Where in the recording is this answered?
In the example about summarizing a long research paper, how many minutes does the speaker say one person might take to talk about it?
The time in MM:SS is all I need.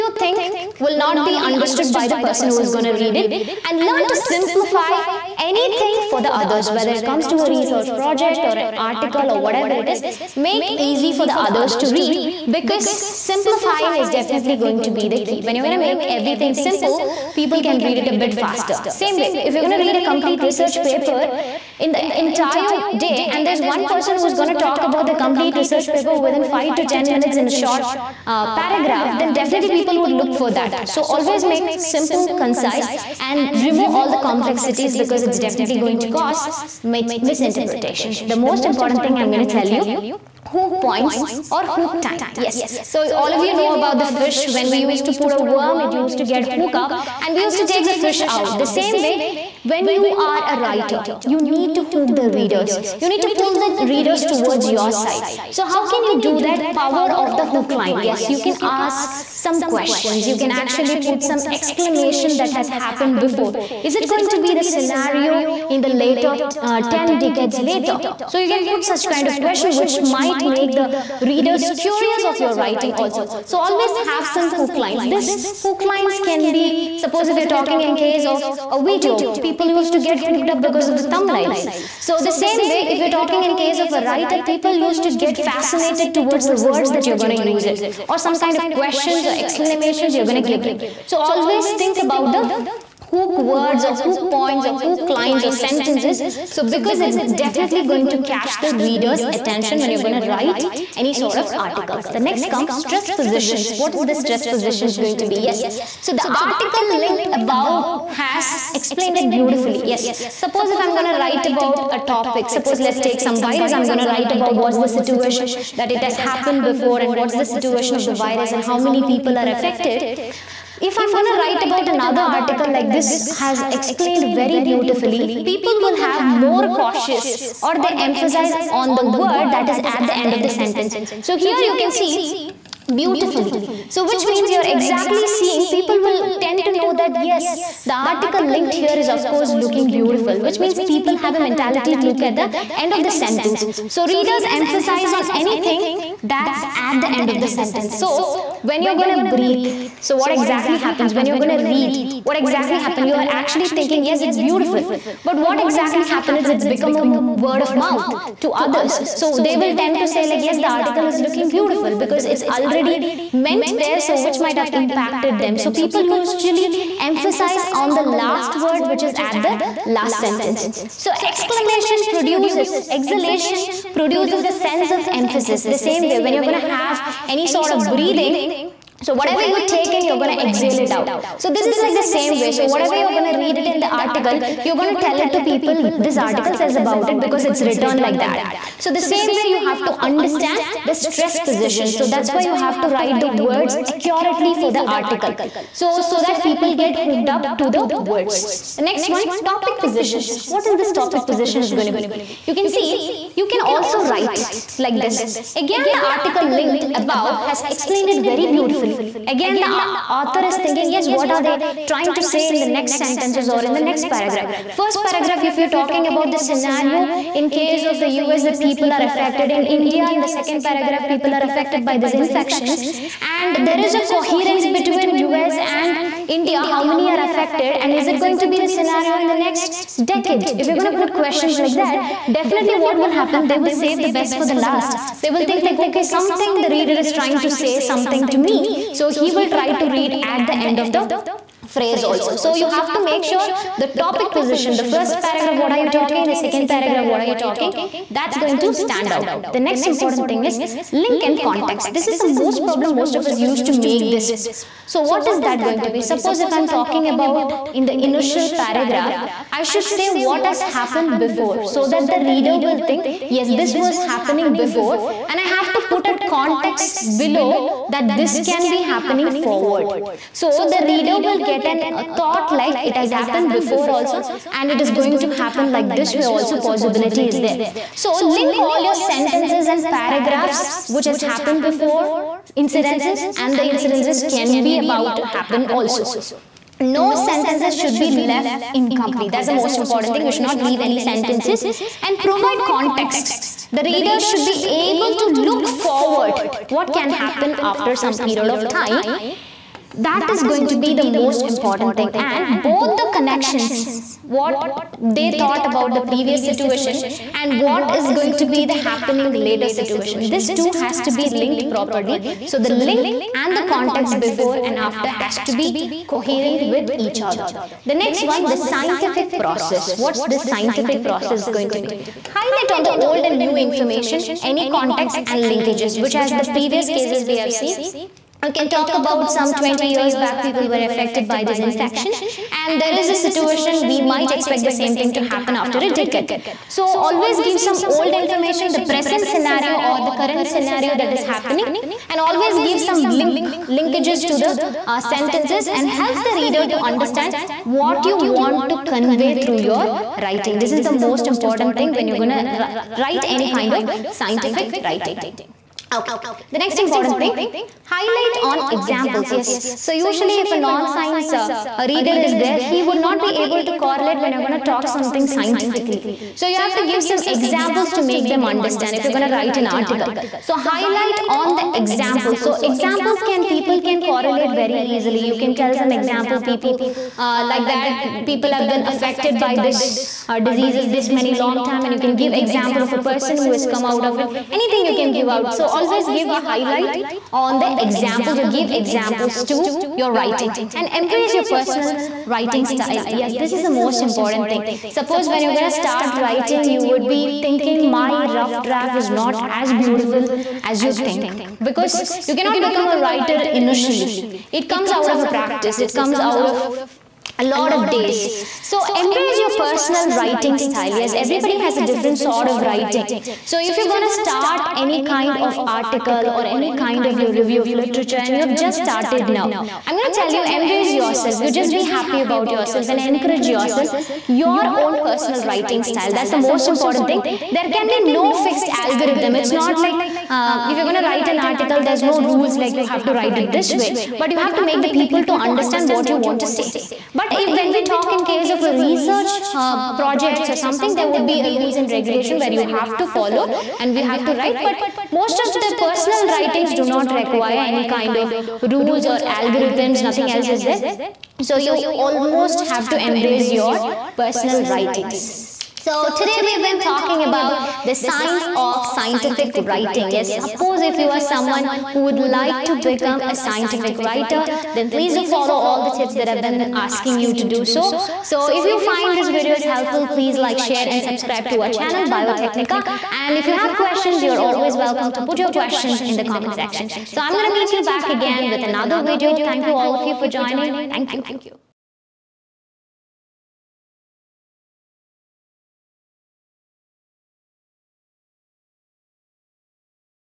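00:26.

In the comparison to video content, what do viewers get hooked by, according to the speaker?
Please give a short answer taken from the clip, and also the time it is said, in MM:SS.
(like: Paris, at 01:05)
thumbnails, at 01:21.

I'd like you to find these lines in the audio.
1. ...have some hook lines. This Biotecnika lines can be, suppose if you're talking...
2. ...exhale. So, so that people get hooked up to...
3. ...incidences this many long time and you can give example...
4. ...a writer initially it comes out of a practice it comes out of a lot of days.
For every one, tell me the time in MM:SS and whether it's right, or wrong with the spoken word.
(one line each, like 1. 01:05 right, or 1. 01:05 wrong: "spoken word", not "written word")
1. 01:13 wrong: "Hook", not "Biotecnika"
2. 03:14 wrong: "article", not "exhale"
3. 06:20 wrong: "diseases", not "incidences"
4. 06:42 right.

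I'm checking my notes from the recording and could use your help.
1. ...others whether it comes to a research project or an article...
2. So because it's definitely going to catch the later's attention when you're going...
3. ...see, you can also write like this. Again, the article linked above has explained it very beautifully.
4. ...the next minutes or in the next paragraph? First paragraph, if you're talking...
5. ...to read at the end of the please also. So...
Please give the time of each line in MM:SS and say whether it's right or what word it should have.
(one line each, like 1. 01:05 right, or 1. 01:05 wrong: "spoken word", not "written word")
1. 00:06 right
2. 01:36 wrong: "reader", not "later"
3. 03:22 right
4. 03:32 wrong: "sentences", not "minutes"
5. 03:59 wrong: "phrase", not "please".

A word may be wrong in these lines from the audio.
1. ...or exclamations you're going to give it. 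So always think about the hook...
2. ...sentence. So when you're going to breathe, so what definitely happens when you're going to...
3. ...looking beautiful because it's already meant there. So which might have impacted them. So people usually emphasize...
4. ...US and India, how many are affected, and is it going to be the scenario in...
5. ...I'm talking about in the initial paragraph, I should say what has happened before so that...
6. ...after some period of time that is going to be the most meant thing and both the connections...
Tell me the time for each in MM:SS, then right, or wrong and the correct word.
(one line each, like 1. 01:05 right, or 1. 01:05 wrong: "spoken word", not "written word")
1. 01:29 right
2. 02:27 wrong: "exactly", not "definitely"
3. 02:41 right
4. 03:45 right
5. 04:16 right
6. 04:57 wrong: "important", not "meant".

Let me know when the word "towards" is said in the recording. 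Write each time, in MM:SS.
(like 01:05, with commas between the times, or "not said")
00:54, 01:26.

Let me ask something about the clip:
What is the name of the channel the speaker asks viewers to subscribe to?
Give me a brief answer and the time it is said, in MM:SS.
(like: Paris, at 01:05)
Biotecnika, at 07:52.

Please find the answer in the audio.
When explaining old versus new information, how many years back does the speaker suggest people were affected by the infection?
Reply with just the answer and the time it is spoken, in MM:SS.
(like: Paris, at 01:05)
20, at 05:29.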